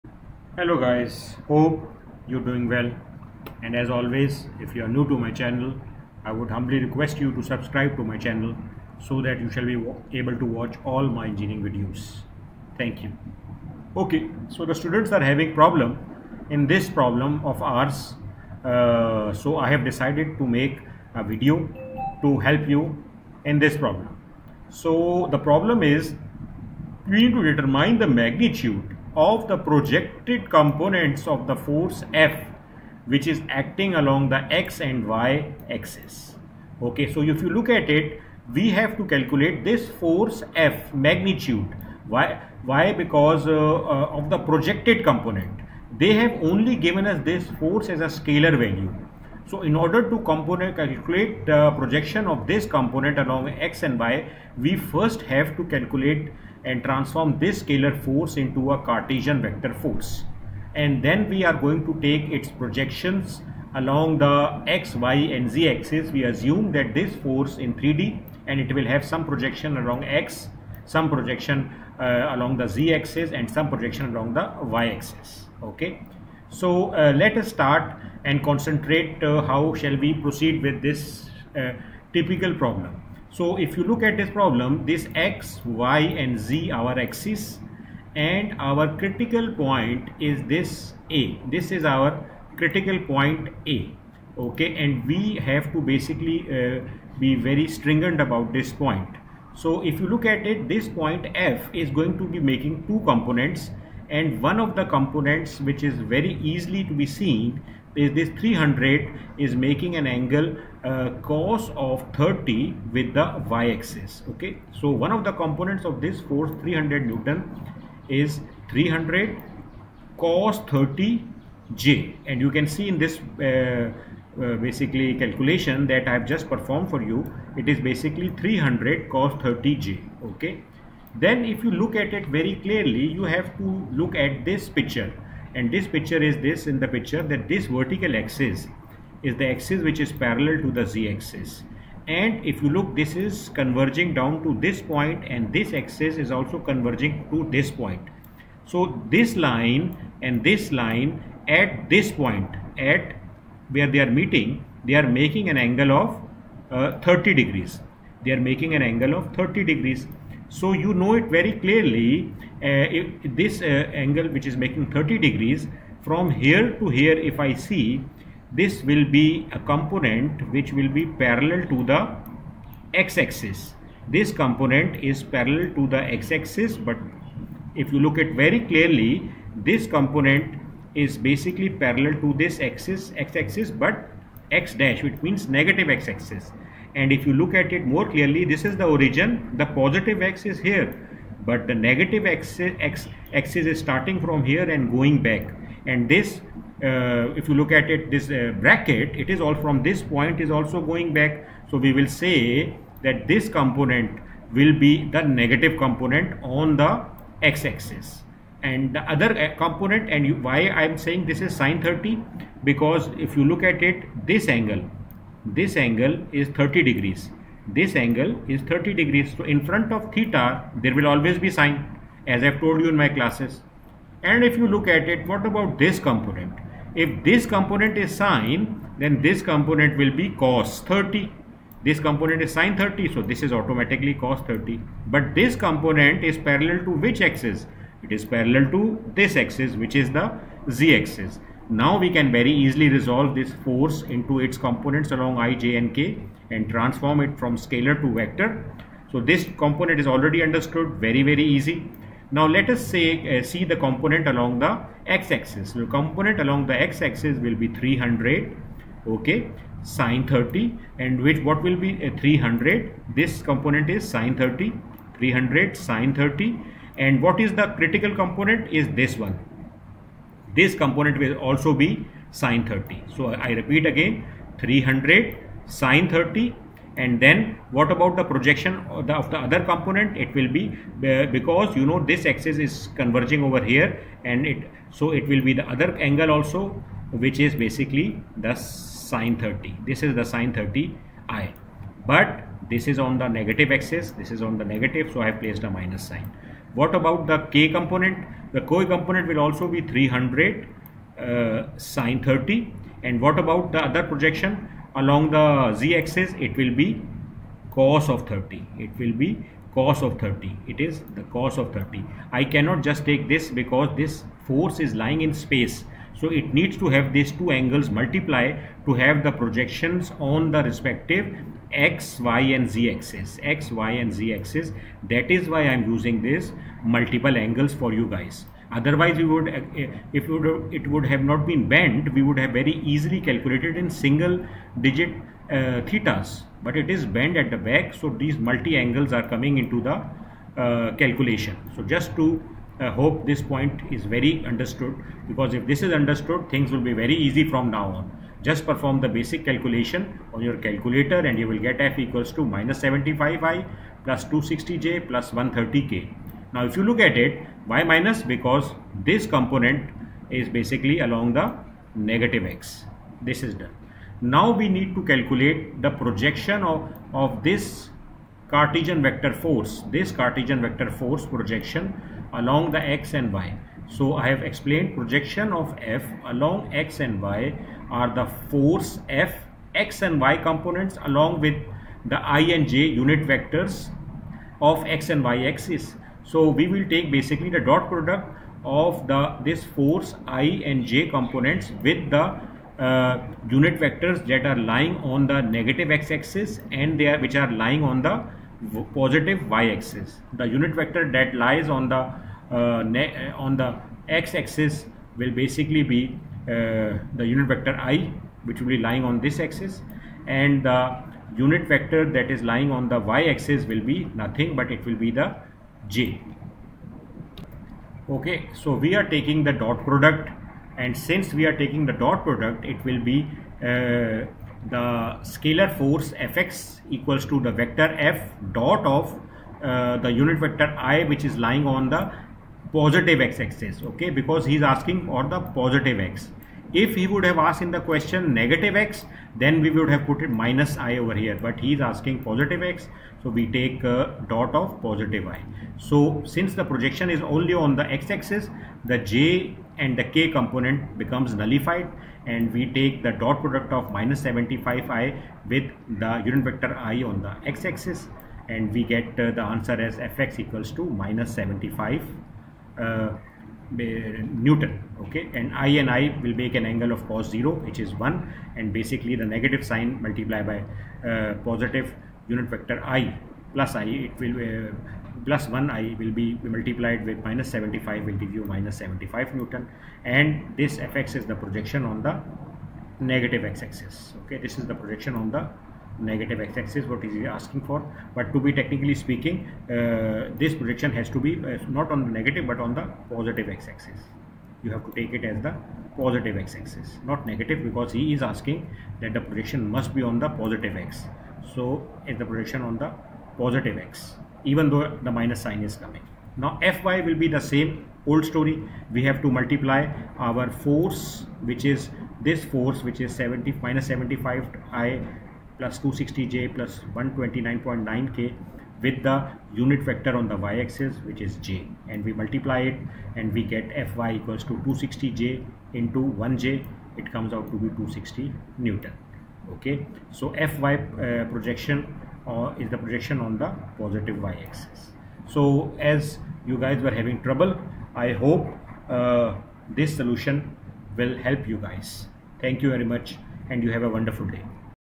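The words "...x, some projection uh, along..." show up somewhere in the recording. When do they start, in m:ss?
1:10.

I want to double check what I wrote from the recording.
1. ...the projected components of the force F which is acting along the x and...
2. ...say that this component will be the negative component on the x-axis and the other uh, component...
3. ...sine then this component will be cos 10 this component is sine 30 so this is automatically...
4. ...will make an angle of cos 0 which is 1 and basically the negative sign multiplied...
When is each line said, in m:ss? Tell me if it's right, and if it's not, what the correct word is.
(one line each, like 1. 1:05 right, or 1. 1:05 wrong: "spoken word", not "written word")
1. 0:29 right
2. 3:22 right
3. 3:48 wrong: "30", not "10"
4. 7:46 right.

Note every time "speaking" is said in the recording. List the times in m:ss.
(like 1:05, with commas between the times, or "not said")
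8:08.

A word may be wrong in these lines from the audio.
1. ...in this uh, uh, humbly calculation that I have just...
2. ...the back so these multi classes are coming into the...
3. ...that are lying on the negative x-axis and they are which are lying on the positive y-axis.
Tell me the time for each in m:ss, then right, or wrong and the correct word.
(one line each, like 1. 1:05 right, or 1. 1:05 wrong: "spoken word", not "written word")
1. 2:02 wrong: "basically", not "humbly"
2. 5:37 wrong: "angles", not "classes"
3. 6:34 right.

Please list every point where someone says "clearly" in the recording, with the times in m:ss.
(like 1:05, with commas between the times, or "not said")
2:12, 2:41, 2:58, 3:08.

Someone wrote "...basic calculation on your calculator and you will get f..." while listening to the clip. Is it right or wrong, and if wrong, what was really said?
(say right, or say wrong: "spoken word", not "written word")
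right.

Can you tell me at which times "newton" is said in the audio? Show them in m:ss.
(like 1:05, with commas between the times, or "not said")
1:57, 7:44, 7:59, 8:48.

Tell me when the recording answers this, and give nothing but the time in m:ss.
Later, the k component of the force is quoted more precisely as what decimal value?
8:36.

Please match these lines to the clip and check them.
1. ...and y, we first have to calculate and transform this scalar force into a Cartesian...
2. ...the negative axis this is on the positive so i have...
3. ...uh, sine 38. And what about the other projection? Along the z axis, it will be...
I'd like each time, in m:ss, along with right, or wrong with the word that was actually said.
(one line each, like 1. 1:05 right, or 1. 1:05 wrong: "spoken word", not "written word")
1. 0:53 right
2. 4:53 wrong: "negative", not "positive"
3. 5:01 wrong: "30", not "38".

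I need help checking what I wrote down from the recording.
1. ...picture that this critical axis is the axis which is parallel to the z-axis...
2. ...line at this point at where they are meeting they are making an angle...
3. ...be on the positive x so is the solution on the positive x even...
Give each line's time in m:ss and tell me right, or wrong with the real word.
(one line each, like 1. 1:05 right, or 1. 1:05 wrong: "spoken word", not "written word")
1. 2:16 wrong: "vertical", not "critical"
2. 2:30 right
3. 8:19 wrong: "projection", not "solution".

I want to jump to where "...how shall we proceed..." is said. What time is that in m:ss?
1:19.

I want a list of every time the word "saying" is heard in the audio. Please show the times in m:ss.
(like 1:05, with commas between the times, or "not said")
3:30.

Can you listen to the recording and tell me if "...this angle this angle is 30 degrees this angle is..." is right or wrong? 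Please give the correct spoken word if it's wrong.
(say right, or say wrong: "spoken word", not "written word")
right.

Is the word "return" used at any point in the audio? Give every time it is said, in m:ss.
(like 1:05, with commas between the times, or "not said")
not said.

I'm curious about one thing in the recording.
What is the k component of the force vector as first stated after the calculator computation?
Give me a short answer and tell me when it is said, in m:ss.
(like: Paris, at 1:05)
130, at 5:55.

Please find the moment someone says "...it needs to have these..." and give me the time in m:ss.
5:16.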